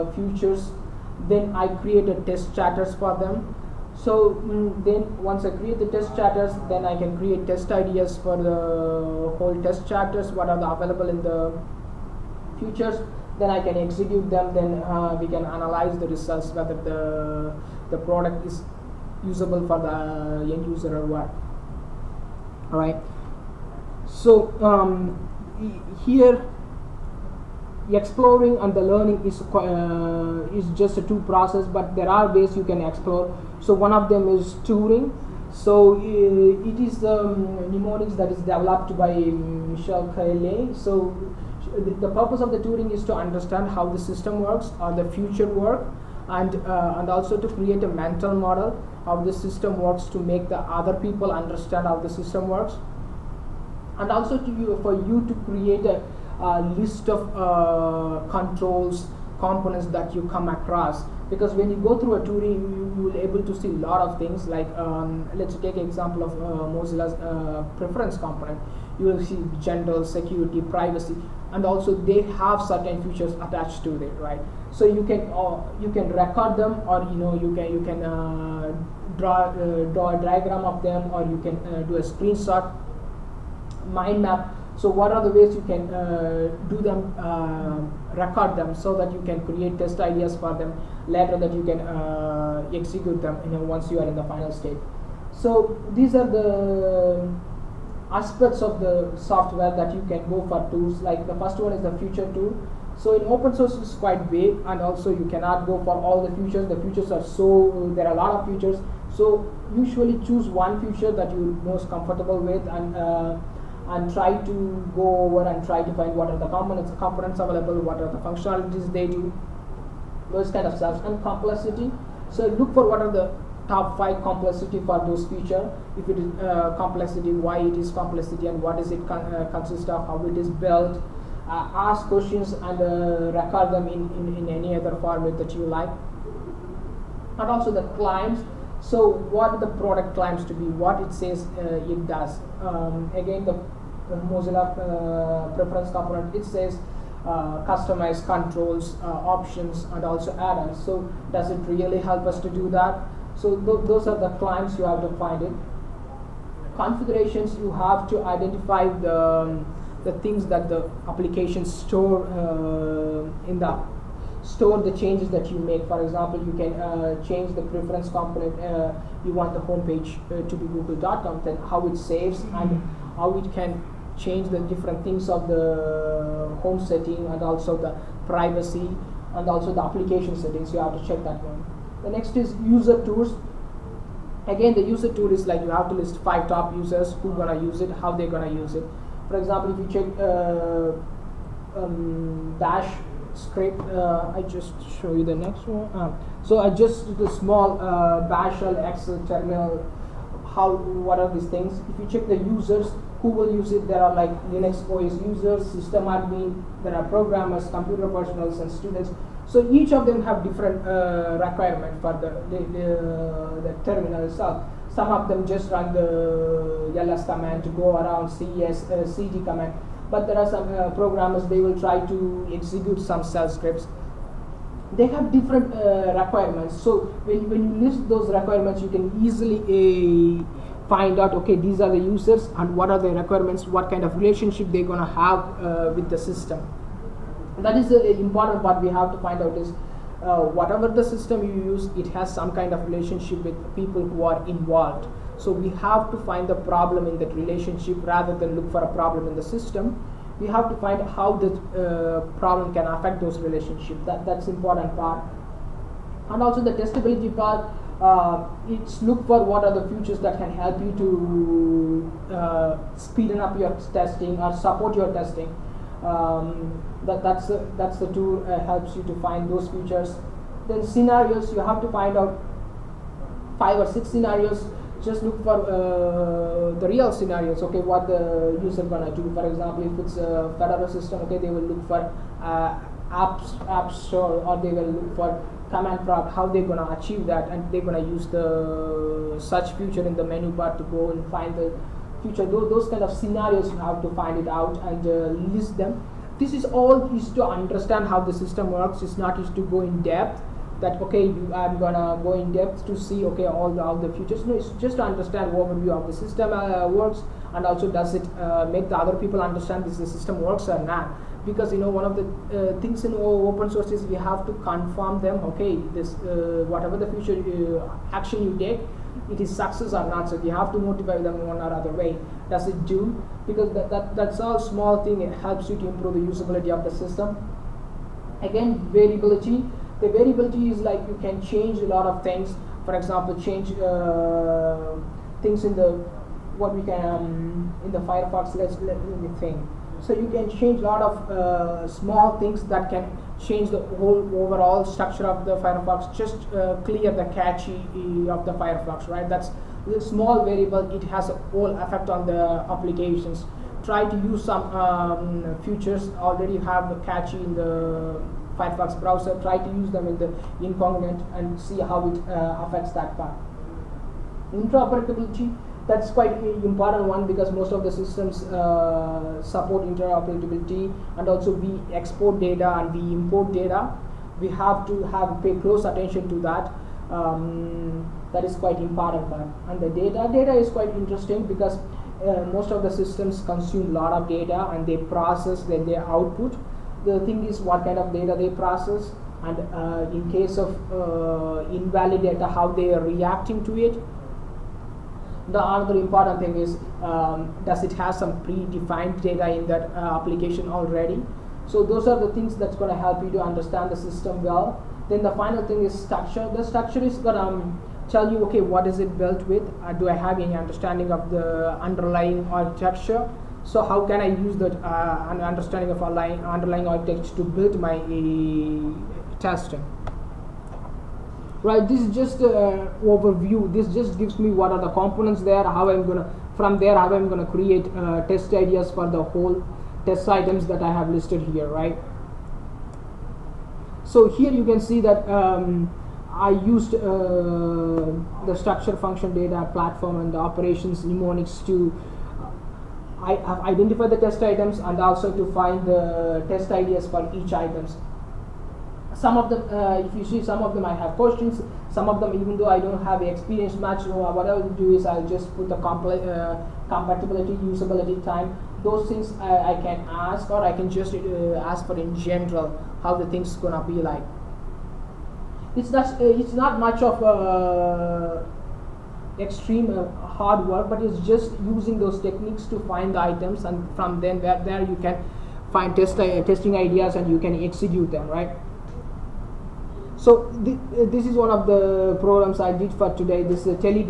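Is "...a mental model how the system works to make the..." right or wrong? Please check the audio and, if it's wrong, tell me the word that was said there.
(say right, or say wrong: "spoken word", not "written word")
right.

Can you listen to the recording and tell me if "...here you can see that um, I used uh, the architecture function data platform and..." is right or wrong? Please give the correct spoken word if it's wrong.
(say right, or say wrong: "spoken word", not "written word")
wrong: "structure", not "architecture".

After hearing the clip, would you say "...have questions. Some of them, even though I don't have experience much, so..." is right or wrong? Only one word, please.
right.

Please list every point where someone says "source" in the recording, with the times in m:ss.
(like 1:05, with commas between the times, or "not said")
1:43, 5:13.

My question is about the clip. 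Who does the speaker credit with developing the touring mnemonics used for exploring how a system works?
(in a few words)
Michael Kelly.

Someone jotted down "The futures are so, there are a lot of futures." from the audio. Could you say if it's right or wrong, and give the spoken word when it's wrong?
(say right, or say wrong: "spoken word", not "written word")
right.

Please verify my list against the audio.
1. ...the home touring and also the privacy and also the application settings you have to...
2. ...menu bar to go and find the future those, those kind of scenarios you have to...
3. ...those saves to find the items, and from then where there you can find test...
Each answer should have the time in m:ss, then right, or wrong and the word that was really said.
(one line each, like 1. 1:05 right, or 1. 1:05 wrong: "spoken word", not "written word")
1. 2:55 wrong: "setting", not "touring"
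2. 4:50 right
3. 7:51 wrong: "techniques", not "saves".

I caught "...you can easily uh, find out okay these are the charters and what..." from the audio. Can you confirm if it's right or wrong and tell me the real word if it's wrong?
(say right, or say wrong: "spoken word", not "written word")
wrong: "users", not "charters".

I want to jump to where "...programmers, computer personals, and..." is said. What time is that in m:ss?
3:27.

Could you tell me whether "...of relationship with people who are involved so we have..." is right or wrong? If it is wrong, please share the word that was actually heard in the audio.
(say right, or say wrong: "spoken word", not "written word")
right.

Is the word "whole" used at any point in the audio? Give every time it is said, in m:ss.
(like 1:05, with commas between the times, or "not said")
0:09, 5:43, 5:51, 7:09.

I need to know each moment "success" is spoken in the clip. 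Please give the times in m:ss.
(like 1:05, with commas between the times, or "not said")
5:19.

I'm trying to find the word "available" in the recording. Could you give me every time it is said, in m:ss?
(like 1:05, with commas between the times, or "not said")
0:10, 1:57.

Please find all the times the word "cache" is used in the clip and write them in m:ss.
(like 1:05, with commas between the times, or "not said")
5:47, 5:57.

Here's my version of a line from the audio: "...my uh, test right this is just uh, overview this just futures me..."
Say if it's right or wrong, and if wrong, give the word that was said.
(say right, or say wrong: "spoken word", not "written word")
wrong: "gives", not "futures".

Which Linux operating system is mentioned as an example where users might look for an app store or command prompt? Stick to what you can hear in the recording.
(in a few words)
Fedora.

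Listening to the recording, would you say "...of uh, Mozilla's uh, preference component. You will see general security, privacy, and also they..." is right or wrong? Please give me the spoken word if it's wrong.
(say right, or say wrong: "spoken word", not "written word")
right.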